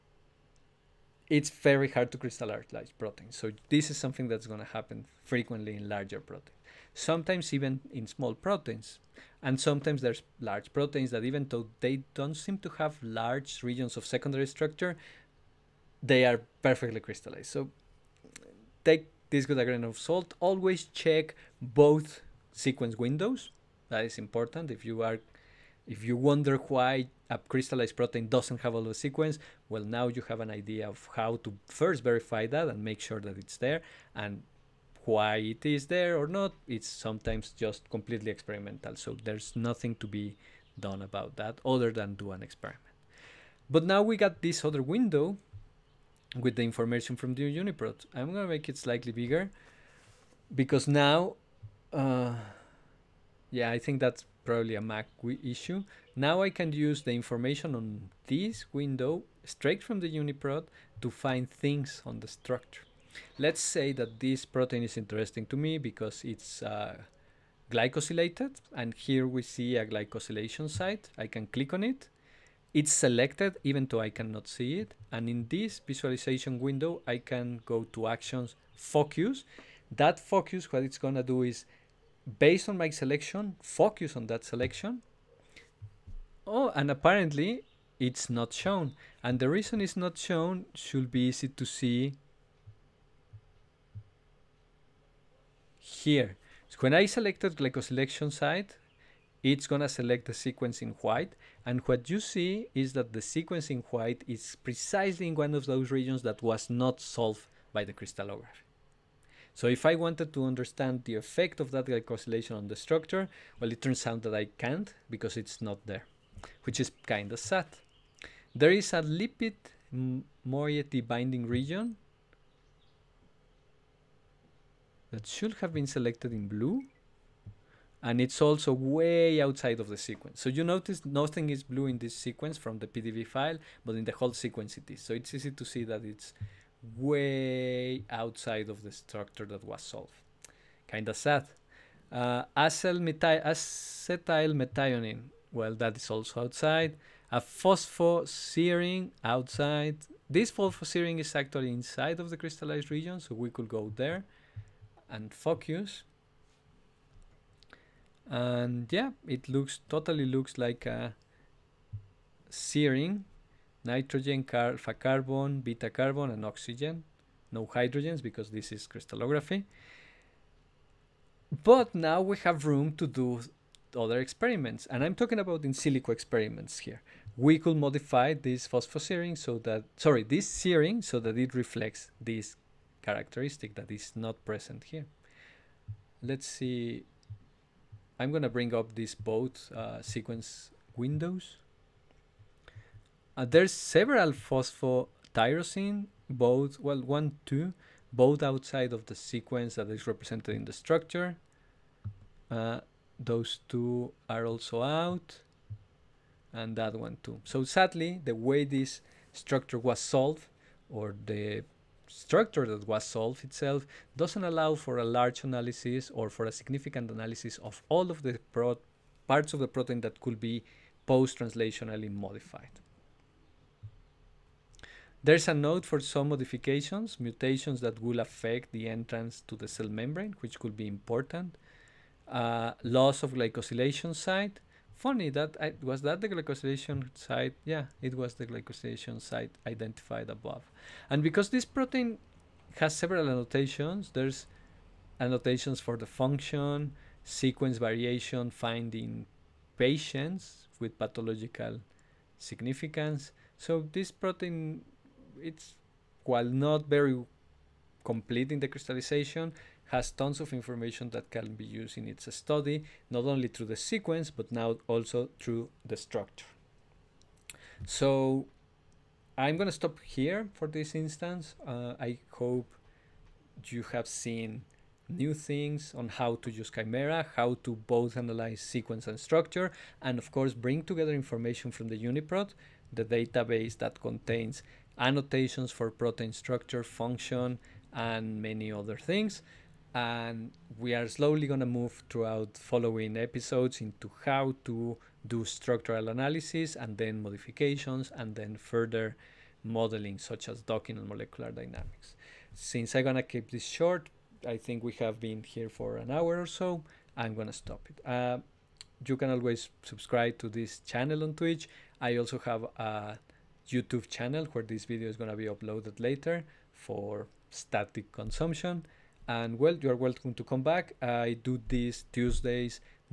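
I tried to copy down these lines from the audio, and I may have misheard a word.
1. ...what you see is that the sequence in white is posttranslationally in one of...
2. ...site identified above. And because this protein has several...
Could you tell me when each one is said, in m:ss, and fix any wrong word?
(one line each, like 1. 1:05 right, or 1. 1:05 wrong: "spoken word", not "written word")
1. 1:41 wrong: "precisely", not "posttranslationally"
2. 3:59 right.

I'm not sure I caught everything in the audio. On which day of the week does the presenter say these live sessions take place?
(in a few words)
Tuesdays.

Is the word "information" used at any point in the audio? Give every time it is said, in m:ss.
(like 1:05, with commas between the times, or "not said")
0:46, 0:57, 4:20, 4:41.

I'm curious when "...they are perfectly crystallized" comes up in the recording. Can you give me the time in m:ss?
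0:16.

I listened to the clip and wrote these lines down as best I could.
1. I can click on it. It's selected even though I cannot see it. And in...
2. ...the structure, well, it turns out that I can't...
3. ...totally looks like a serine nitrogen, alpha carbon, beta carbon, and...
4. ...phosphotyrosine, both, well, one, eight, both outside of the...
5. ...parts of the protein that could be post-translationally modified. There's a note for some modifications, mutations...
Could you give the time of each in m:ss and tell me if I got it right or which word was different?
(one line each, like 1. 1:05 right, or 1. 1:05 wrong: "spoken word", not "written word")
1. 1:11 right
2. 1:52 right
3. 2:39 right
4. 3:14 wrong: "two", not "eight"
5. 3:39 right.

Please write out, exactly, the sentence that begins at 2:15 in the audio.
So it's easy to see that it's way outside of the structure that was solved.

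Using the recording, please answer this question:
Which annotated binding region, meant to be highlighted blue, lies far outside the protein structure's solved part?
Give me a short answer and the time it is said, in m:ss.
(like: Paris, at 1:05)
Lipid moiety binding region, at 1:59.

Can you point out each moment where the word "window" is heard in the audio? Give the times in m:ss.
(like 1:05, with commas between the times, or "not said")
0:22, 0:44, 0:58, 1:16, 3:10.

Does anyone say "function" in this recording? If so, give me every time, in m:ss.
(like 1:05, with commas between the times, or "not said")
4:06, 4:46.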